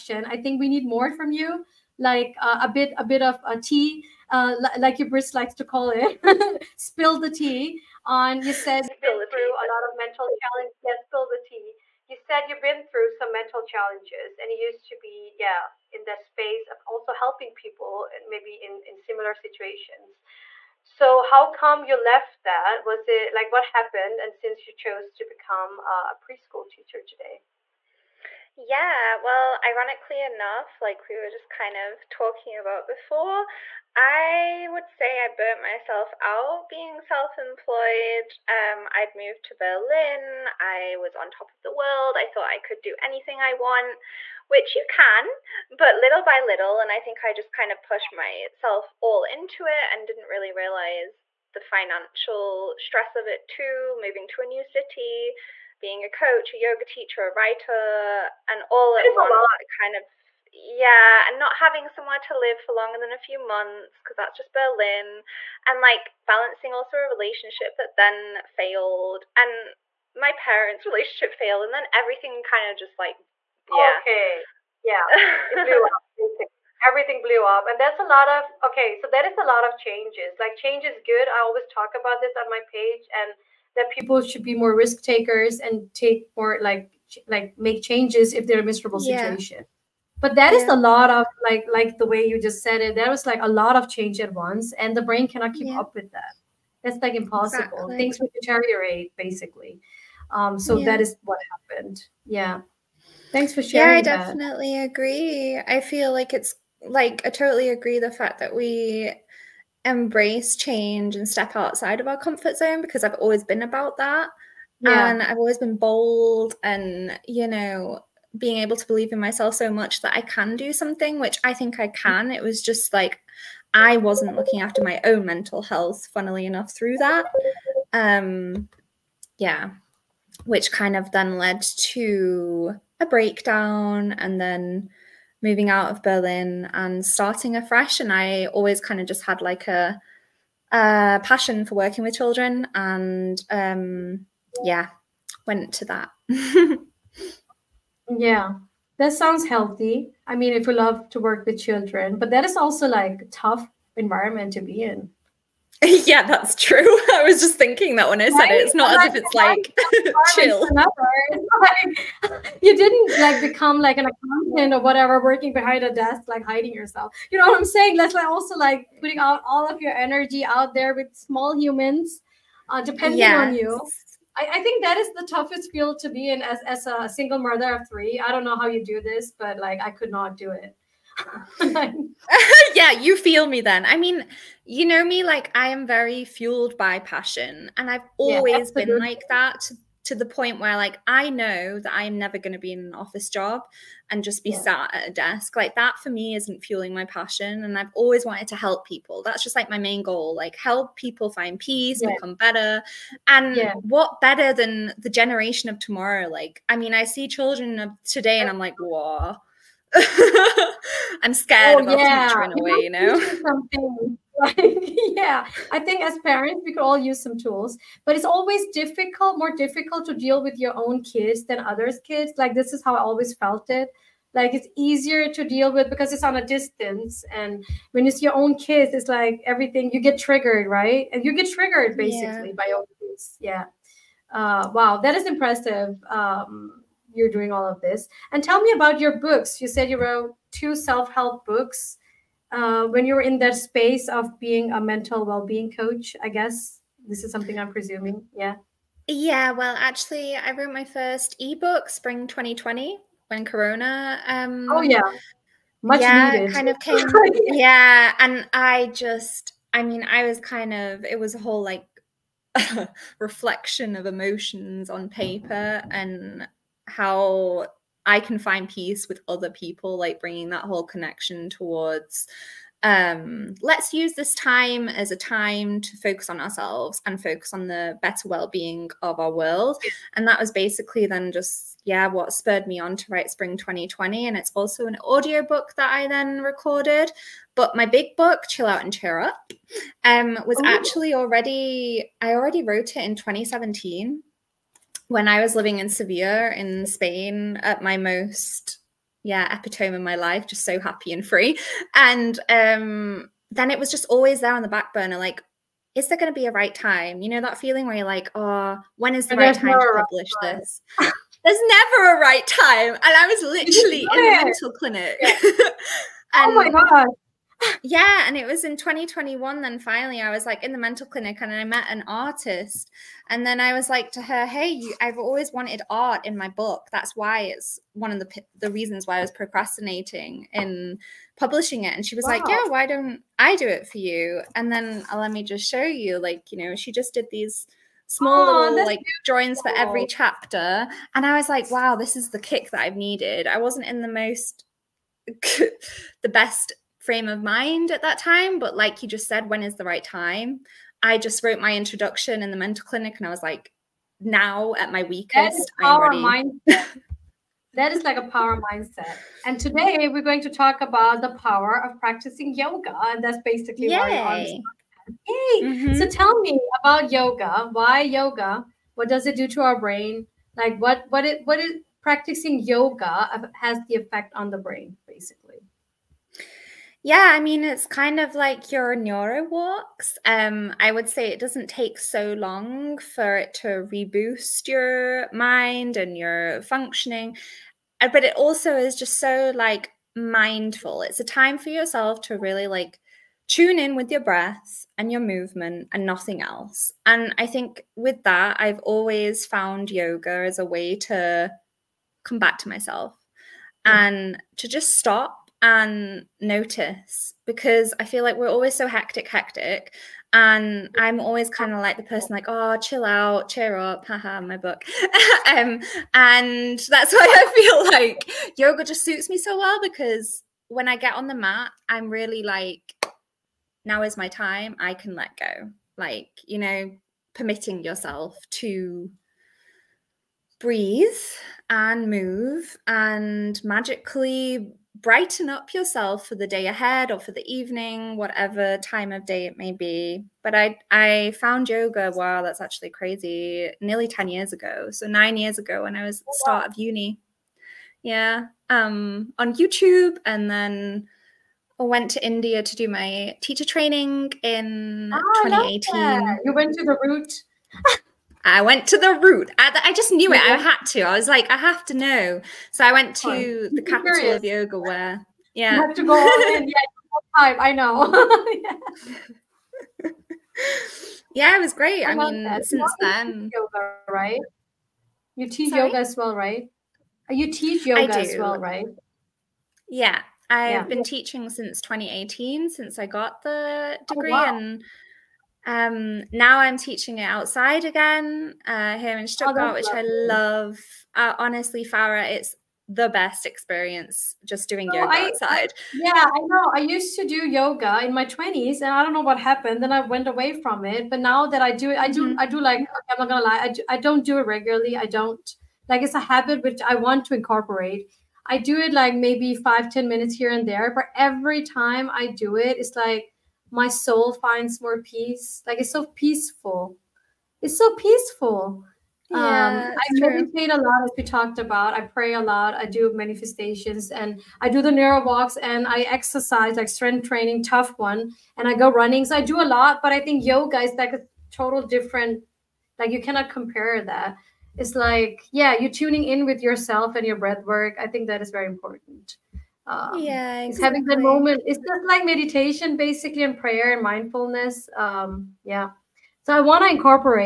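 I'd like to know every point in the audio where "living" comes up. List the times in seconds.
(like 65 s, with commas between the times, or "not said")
295 s.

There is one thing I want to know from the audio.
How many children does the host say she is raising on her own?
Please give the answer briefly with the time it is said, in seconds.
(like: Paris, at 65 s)
3, at 177 s.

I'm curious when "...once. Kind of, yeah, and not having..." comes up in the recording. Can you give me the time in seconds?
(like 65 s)
59 s.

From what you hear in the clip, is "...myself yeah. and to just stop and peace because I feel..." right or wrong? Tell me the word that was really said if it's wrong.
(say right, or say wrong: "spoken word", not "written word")
wrong: "notice", not "peace".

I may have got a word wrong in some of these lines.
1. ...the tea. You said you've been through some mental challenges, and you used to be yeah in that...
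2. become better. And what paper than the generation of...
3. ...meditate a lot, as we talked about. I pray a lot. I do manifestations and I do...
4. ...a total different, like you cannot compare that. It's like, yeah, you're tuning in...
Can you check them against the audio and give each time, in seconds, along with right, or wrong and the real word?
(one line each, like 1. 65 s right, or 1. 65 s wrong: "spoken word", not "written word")
1. 11 s right
2. 202 s wrong: "better", not "paper"
3. 520 s right
4. 531 s right.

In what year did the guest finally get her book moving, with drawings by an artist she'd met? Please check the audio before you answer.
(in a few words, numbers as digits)
2021.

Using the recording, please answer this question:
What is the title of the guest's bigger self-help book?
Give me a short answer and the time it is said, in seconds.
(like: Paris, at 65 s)
Chill Out and Cheer Up, at 288 s.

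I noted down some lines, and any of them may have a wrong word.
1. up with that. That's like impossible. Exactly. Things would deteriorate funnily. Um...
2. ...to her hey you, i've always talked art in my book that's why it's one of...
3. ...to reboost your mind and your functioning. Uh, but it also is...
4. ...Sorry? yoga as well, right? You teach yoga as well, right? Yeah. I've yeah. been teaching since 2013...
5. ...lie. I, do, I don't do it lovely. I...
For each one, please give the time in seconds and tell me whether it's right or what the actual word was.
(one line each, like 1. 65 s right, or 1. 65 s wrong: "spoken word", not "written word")
1. 95 s wrong: "basically", not "funnily"
2. 324 s wrong: "wanted", not "talked"
3. 383 s right
4. 475 s wrong: "2018", not "2013"
5. 503 s wrong: "regularly", not "lovely".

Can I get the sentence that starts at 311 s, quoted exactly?
there's never a right time and i was literally in a mental clinic yeah.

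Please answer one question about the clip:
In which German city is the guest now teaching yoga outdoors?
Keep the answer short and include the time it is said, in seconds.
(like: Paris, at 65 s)
Stuttgart, at 489 s.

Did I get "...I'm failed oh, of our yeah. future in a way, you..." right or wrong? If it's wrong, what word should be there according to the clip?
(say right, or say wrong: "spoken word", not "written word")
wrong: "scared", not "failed".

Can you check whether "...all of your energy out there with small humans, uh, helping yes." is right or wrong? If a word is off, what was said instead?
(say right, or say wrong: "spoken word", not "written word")
wrong: "depending", not "helping".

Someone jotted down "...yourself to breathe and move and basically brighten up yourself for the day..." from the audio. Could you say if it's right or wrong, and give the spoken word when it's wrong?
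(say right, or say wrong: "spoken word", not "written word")
wrong: "magically", not "basically".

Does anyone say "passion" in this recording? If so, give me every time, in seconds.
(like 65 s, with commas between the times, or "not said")
141 s, 186 s, 197 s.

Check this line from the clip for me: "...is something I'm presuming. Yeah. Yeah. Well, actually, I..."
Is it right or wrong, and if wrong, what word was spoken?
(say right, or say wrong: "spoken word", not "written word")
right.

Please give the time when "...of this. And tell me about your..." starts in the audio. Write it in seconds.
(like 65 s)
237 s.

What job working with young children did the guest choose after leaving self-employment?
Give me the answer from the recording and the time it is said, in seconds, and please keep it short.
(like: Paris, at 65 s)
preschool teacher, at 26 s.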